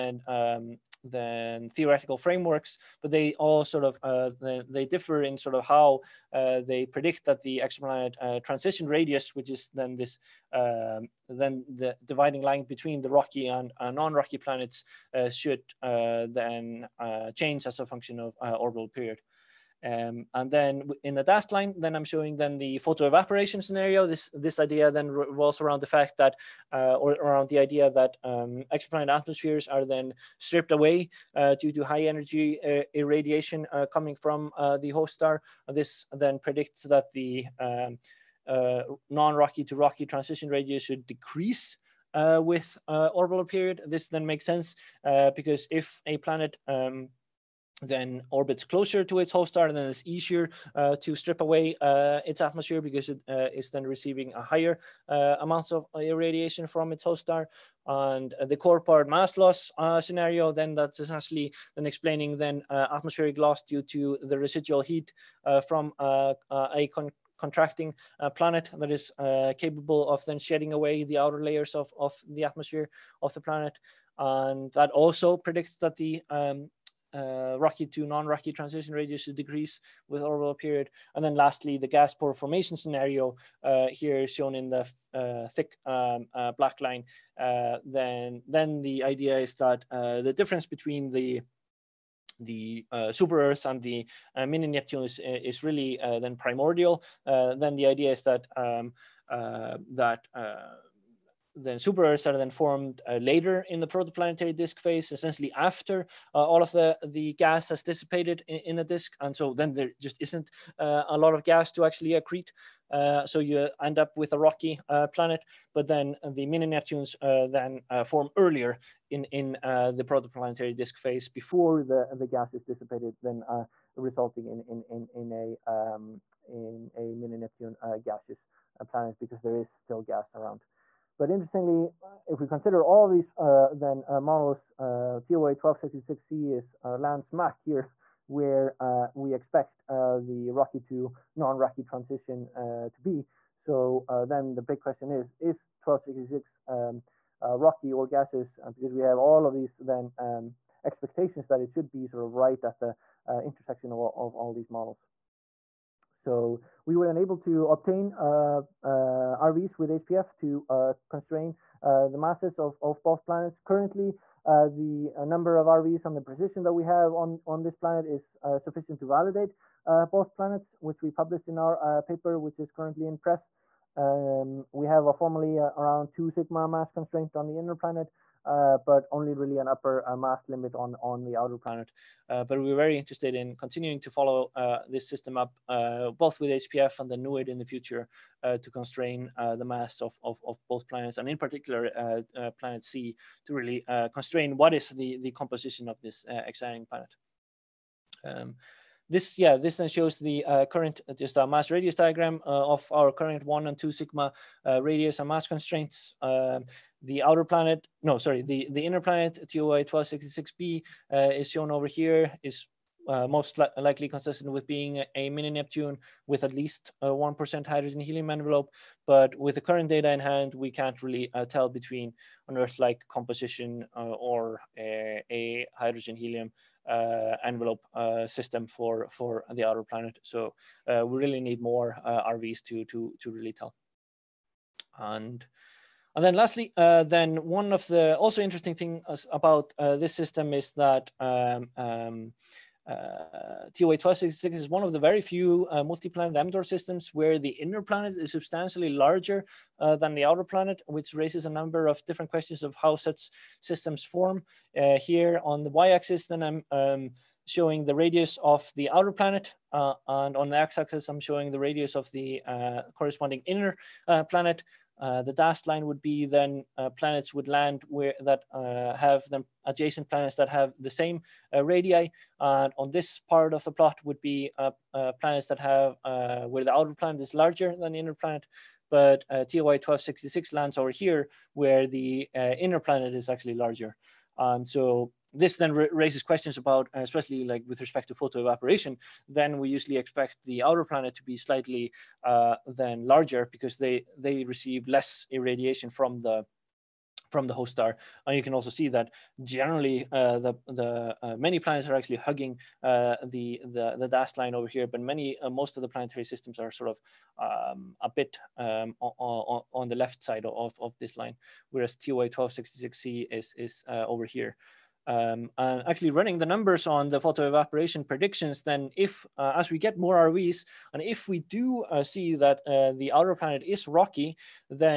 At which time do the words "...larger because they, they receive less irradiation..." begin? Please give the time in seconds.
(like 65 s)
293 s.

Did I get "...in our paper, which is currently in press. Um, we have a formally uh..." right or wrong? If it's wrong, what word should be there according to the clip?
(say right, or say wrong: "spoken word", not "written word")
right.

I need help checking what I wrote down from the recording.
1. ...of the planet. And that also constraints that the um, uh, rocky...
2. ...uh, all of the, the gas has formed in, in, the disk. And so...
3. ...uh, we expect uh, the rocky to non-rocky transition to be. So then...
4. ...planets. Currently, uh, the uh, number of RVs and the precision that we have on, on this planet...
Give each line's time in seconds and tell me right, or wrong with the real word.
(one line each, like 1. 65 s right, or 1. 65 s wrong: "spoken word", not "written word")
1. 73 s wrong: "predicts", not "constraints"
2. 106 s wrong: "dissipated", not "formed"
3. 138 s right
4. 163 s right.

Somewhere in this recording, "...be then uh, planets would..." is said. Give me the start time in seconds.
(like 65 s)
266 s.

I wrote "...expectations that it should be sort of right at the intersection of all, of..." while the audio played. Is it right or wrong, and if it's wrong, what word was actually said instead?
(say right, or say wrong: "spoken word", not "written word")
right.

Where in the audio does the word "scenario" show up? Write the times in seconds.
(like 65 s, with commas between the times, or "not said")
23 s, 59 s, 82 s.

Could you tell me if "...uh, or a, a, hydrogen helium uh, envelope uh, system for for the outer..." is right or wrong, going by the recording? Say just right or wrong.
right.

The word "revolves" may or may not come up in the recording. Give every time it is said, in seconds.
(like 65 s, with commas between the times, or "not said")
25 s.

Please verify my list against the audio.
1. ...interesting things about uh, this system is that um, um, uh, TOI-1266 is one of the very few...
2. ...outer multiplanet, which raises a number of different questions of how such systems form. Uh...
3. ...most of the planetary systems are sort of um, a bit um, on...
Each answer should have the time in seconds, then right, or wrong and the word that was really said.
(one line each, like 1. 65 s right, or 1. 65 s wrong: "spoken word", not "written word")
1. 238 s right
2. 250 s wrong: "planet", not "multiplanet"
3. 305 s right.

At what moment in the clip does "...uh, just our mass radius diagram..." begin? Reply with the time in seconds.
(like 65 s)
201 s.